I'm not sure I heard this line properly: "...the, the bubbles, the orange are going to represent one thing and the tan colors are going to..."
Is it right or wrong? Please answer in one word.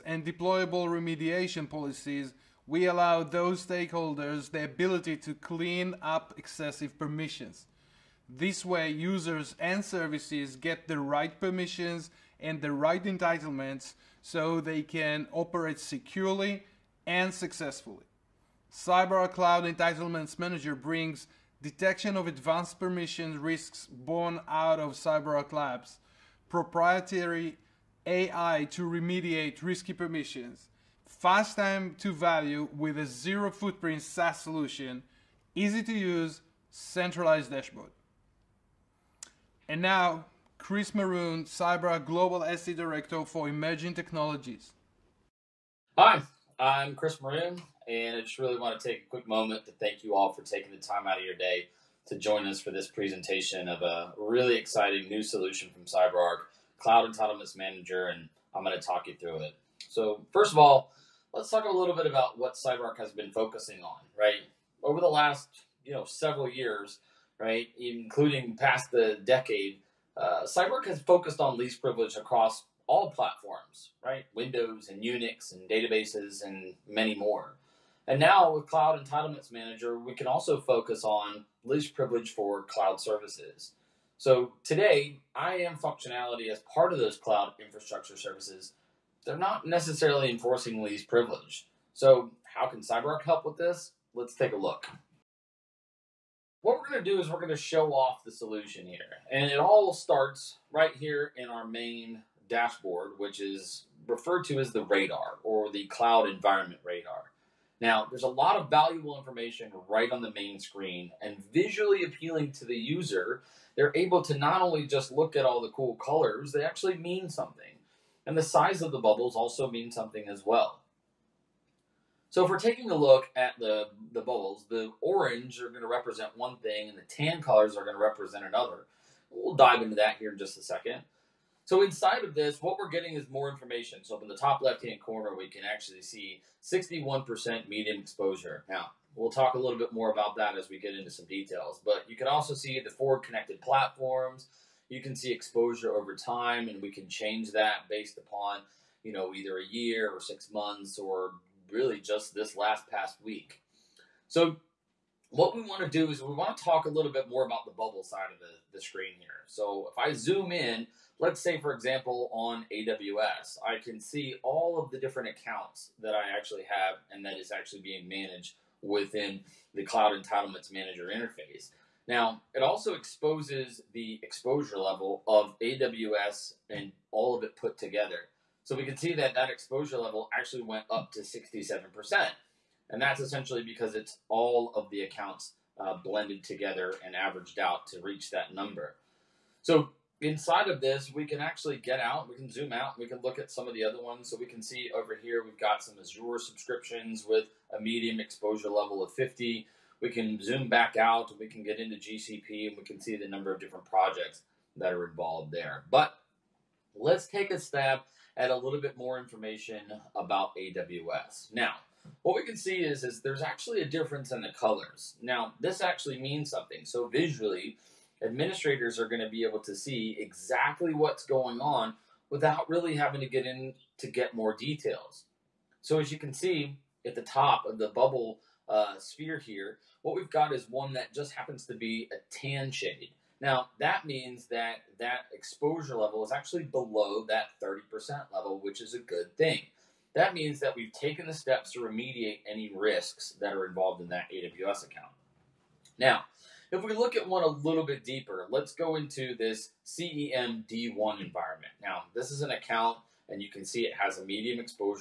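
right.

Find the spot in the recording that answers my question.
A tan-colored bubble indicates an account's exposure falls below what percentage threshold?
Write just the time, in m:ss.
3:57.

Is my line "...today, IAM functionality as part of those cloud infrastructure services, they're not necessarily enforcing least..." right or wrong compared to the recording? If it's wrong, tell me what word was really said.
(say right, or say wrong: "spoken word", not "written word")
right.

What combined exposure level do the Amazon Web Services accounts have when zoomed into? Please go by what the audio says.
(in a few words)
67%.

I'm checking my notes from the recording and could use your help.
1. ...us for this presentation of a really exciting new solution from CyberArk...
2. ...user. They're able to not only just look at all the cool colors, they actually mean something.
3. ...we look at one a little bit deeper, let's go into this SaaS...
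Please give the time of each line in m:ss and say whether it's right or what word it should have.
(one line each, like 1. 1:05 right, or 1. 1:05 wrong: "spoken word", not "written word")
1. 0:52 right
2. 1:52 right
3. 4:06 wrong: "CEM", not "SaaS".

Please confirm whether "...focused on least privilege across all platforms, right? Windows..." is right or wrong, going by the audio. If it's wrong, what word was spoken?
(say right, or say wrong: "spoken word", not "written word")
right.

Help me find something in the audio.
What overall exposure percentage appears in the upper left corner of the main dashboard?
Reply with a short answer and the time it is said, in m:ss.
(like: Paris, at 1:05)
61%, at 2:16.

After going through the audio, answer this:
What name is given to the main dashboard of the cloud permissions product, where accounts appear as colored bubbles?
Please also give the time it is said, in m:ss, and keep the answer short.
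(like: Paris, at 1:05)
cloud environment radar, at 1:45.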